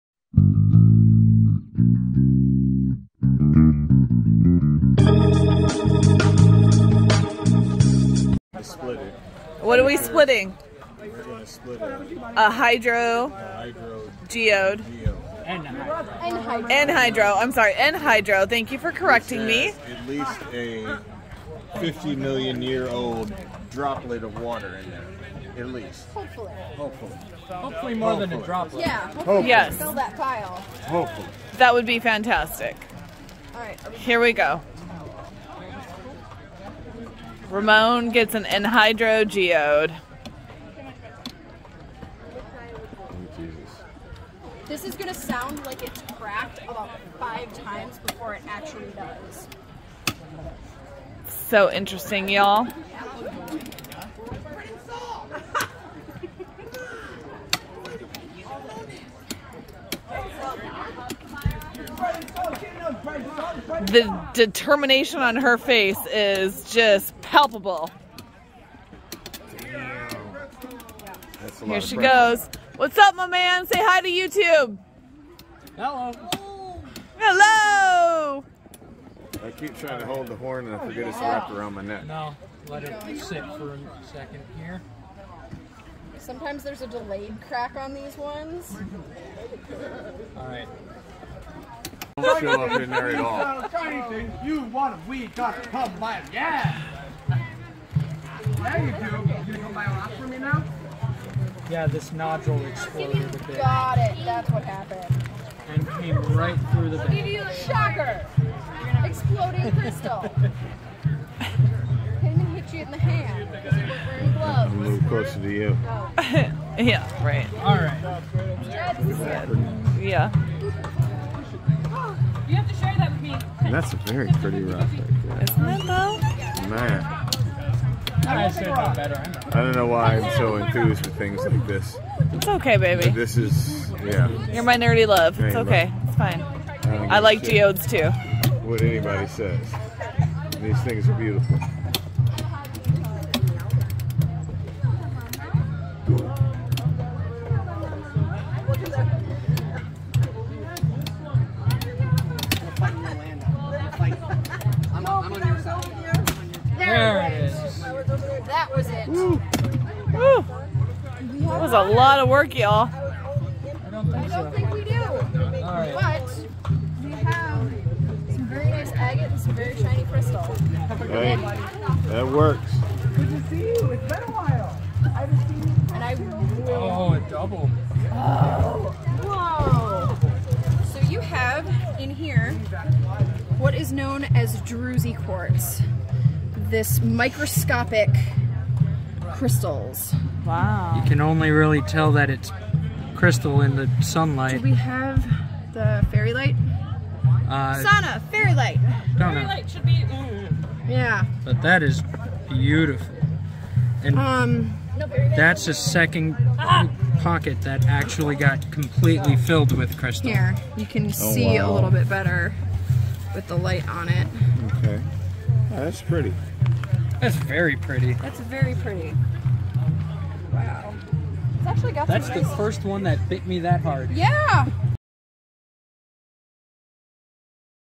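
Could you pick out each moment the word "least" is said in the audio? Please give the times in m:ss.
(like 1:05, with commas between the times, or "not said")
0:20, 0:25.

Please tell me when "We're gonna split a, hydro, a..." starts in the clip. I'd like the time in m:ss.
0:10.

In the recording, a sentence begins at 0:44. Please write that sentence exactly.
This is gonna sound like it's cracked about five times before it actually does.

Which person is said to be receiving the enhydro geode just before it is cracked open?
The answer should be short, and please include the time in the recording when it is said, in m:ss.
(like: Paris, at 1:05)
Ramon, at 0:37.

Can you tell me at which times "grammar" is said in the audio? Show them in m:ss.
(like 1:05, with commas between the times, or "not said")
not said.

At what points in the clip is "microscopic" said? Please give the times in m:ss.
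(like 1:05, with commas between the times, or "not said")
3:07.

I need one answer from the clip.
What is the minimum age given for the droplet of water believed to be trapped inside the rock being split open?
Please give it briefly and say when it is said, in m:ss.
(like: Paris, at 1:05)
50 million years, at 0:21.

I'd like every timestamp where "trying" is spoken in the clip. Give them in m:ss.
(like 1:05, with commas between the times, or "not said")
1:19.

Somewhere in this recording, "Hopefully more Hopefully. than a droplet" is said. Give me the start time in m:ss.
0:27.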